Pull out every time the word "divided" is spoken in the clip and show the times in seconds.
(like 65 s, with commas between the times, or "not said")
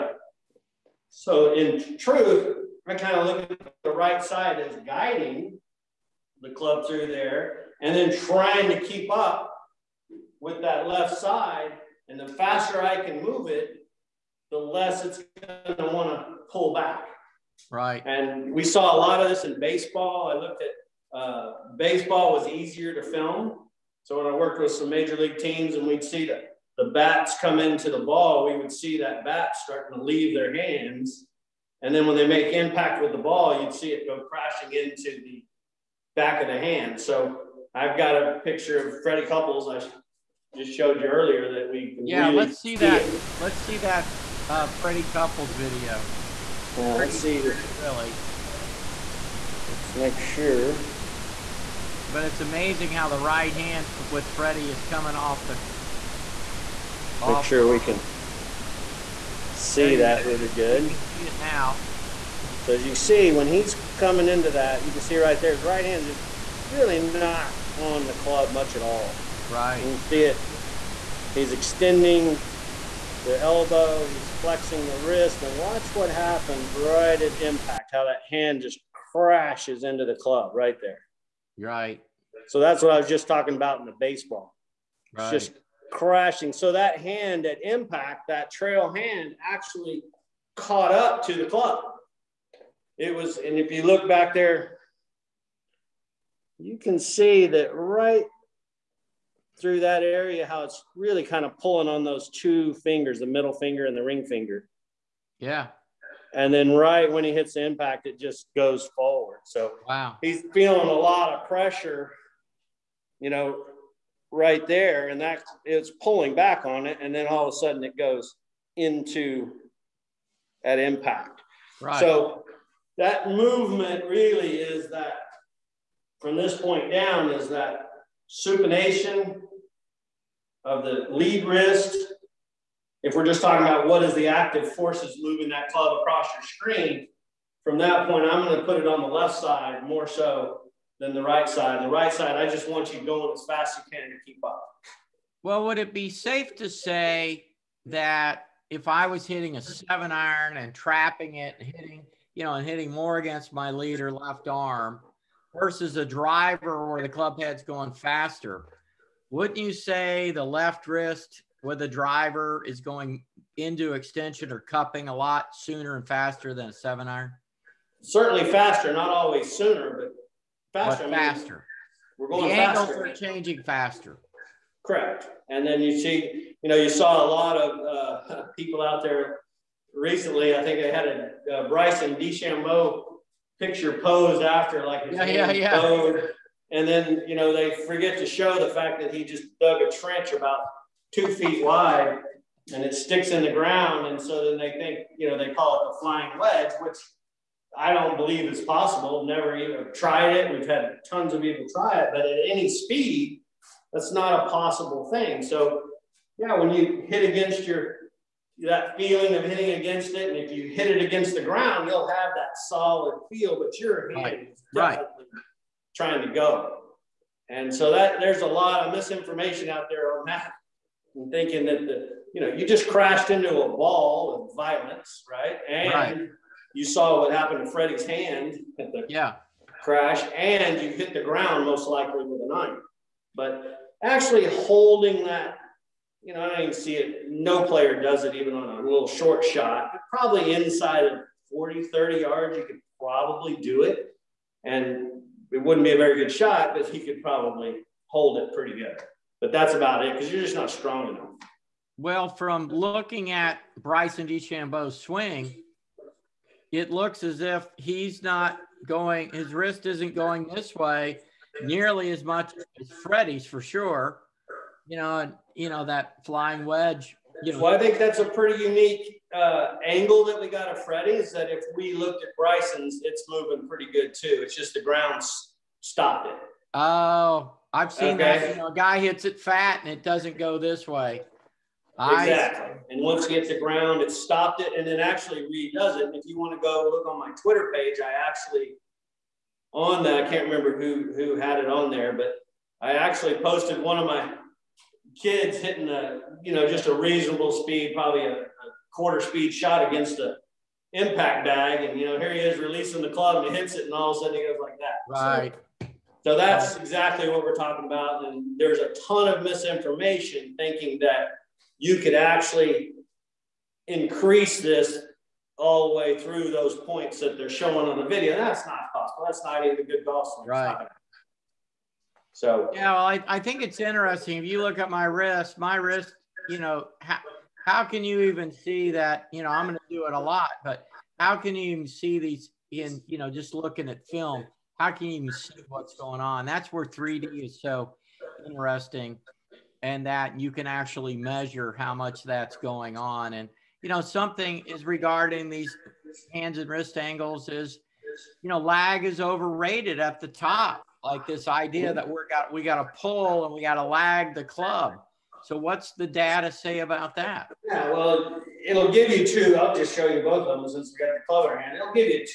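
not said.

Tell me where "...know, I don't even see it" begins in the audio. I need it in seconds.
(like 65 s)
236 s.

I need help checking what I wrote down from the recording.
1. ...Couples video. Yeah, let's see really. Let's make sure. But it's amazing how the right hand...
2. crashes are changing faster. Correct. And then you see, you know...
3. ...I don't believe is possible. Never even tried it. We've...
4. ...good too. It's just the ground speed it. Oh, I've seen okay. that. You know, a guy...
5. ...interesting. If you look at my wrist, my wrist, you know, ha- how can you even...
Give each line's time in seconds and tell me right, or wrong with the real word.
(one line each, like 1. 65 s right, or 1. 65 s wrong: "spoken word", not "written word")
1. 45 s right
2. 172 s wrong: "angles", not "crashes"
3. 197 s right
4. 273 s wrong: "stopped", not "speed"
5. 323 s right.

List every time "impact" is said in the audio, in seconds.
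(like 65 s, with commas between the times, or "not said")
32 s, 77 s, 87 s, 107 s, 120 s, 300 s.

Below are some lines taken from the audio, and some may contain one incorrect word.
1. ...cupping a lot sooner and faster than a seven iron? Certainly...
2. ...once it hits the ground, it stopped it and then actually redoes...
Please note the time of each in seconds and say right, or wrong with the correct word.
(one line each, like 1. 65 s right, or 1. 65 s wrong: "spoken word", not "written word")
1. 164 s right
2. 283 s right.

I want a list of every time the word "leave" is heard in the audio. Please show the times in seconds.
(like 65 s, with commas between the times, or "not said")
30 s.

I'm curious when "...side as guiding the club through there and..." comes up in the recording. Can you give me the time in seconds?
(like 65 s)
4 s.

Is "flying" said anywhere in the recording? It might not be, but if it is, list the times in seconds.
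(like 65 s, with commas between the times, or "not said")
196 s, 266 s.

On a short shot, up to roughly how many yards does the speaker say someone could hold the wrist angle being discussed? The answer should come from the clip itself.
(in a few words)
40 yards.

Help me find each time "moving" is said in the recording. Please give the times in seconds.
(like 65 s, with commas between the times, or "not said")
135 s, 273 s.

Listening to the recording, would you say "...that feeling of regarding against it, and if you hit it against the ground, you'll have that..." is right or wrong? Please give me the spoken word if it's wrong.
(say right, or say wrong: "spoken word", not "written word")
wrong: "hitting", not "regarding".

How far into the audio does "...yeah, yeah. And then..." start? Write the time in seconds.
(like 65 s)
185 s.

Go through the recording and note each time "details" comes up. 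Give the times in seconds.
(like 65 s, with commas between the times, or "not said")
not said.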